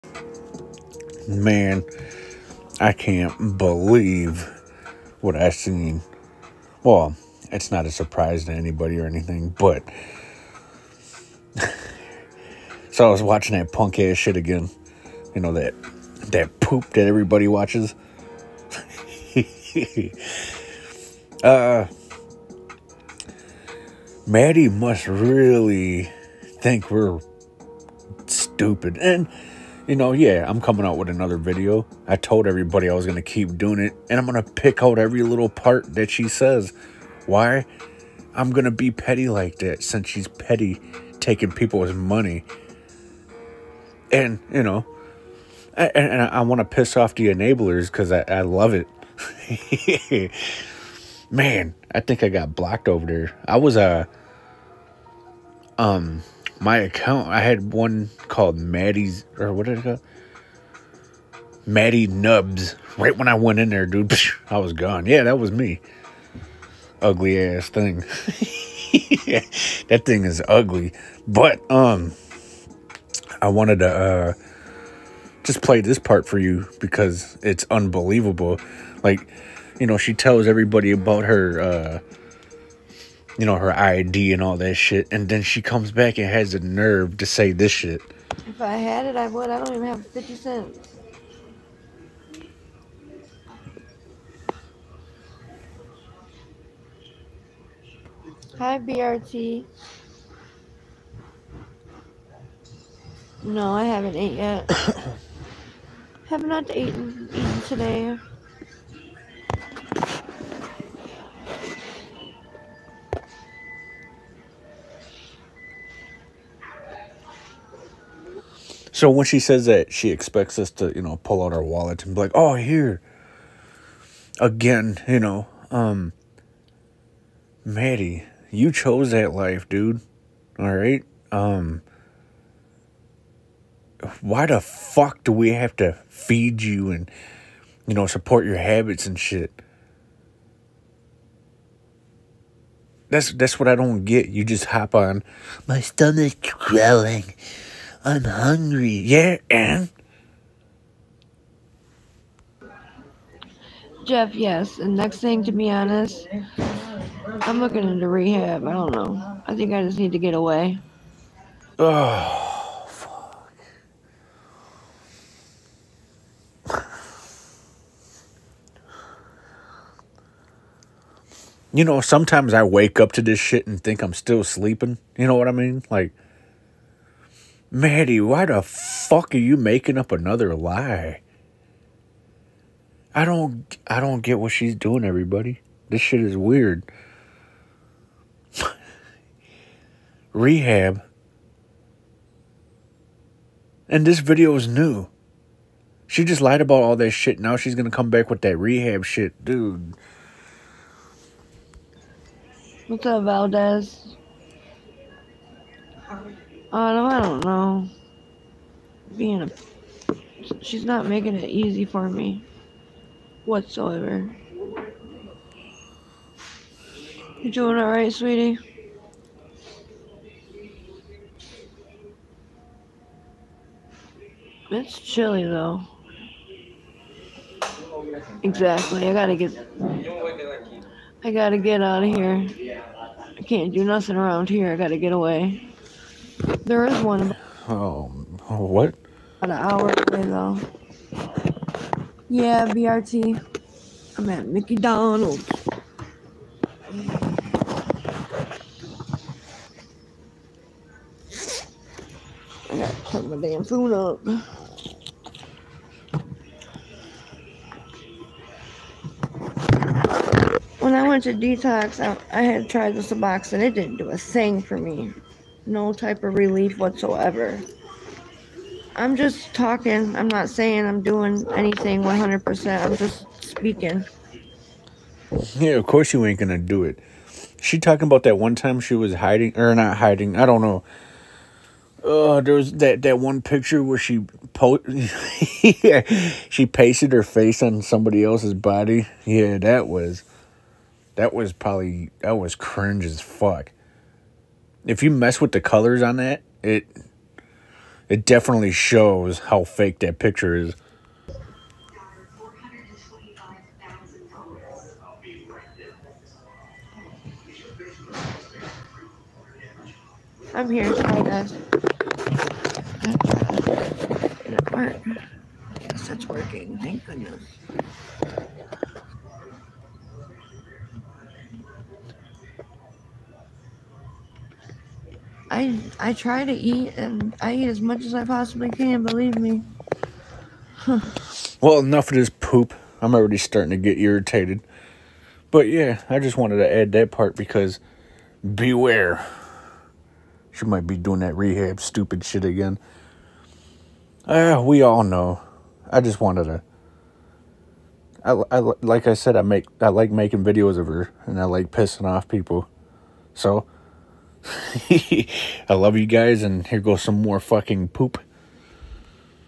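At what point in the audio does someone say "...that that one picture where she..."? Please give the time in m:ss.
4:42.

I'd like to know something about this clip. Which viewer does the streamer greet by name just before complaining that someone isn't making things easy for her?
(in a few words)
Valdez.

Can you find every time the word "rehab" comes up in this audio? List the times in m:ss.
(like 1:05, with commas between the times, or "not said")
2:38, 3:10, 3:18, 5:41.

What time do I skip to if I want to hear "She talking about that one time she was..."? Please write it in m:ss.
4:37.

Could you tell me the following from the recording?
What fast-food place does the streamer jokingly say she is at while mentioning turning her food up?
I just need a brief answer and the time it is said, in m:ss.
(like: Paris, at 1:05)
Mickey Donald's, at 4:04.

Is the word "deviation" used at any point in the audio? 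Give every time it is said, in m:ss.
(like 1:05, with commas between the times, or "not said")
not said.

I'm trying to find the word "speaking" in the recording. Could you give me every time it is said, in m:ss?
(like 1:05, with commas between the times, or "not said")
4:33.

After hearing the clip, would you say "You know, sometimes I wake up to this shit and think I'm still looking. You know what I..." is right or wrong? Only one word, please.
wrong.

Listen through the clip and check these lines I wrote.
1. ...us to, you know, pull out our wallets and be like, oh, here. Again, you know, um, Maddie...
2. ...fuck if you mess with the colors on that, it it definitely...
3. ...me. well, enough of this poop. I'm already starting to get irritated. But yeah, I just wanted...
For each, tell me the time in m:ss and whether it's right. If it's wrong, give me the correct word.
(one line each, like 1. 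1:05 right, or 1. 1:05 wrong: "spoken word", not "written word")
1. 2:00 right
2. 4:53 right
3. 5:29 right.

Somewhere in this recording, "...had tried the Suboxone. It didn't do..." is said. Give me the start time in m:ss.
4:22.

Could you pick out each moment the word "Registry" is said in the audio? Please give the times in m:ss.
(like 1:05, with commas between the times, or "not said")
not said.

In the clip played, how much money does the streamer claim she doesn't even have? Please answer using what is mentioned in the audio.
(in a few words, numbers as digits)
50 cents.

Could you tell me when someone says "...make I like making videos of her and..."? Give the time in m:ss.
5:49.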